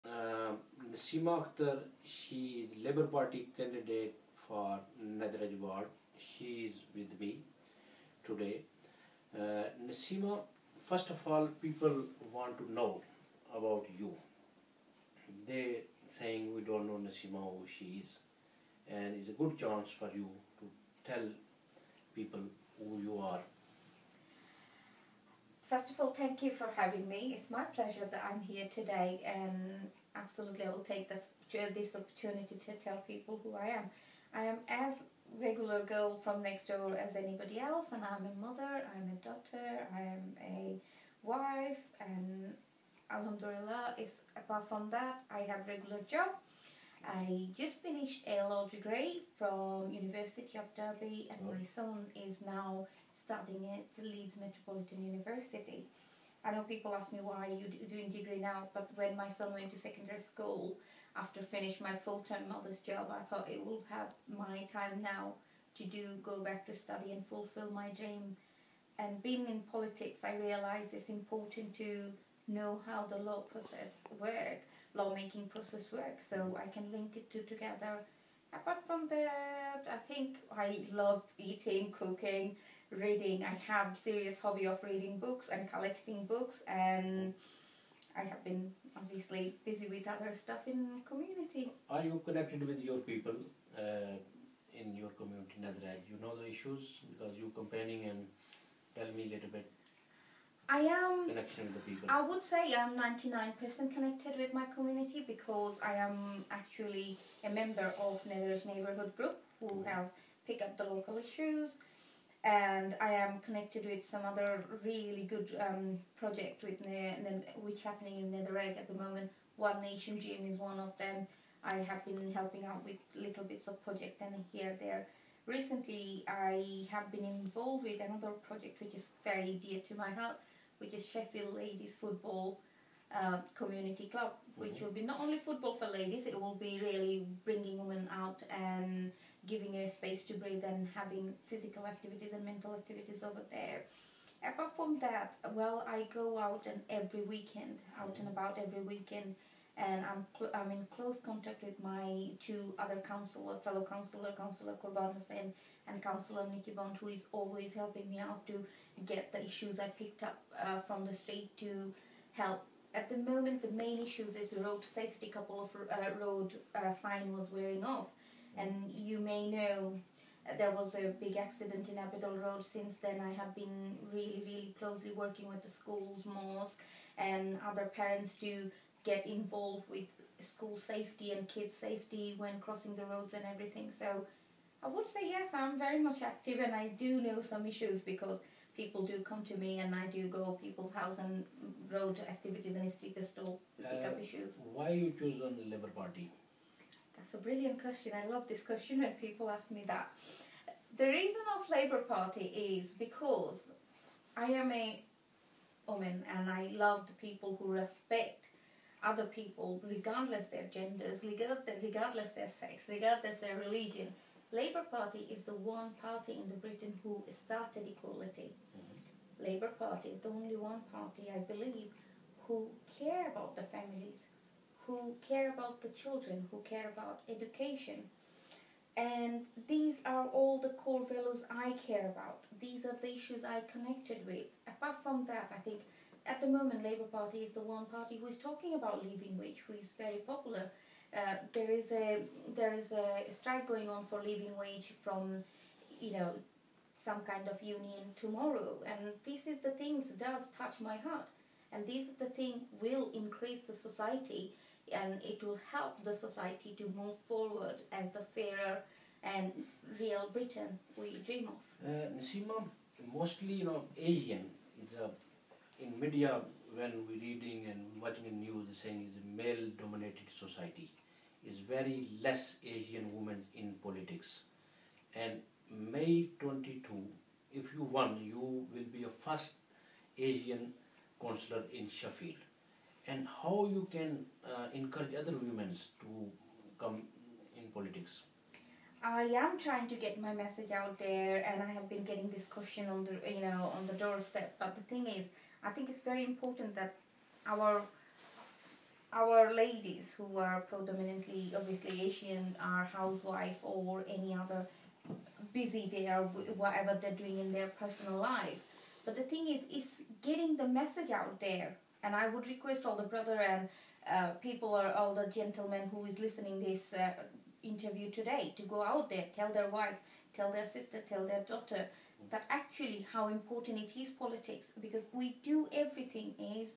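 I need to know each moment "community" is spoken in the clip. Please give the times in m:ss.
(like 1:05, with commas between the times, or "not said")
1:31, 1:35, 1:44, 2:13.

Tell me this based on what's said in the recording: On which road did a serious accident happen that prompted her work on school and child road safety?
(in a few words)
Abbeydale Road.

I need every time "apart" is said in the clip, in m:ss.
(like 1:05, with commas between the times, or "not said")
0:44, 1:18, 2:24, 3:54.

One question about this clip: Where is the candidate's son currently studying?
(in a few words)
Leeds Metropolitan University.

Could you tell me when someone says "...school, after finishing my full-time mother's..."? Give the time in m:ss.
1:00.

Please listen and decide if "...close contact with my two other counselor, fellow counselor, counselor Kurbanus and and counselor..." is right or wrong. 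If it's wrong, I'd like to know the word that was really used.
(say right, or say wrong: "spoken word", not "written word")
right.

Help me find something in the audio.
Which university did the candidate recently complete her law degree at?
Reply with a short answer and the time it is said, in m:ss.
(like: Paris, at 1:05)
University of Derby, at 0:49.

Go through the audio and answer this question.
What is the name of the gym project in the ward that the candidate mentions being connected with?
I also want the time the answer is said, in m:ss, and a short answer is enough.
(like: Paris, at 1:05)
One Nation Gym, at 1:59.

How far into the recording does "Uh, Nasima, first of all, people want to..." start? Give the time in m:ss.
0:09.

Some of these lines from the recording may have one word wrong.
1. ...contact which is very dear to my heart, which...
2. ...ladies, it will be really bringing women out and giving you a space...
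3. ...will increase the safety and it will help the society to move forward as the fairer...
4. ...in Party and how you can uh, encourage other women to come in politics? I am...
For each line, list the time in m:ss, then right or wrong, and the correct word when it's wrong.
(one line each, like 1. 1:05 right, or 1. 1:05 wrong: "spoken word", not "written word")
1. 2:08 wrong: "project", not "contact"
2. 2:15 right
3. 4:12 wrong: "society", not "safety"
4. 4:41 wrong: "Sheffield", not "Party".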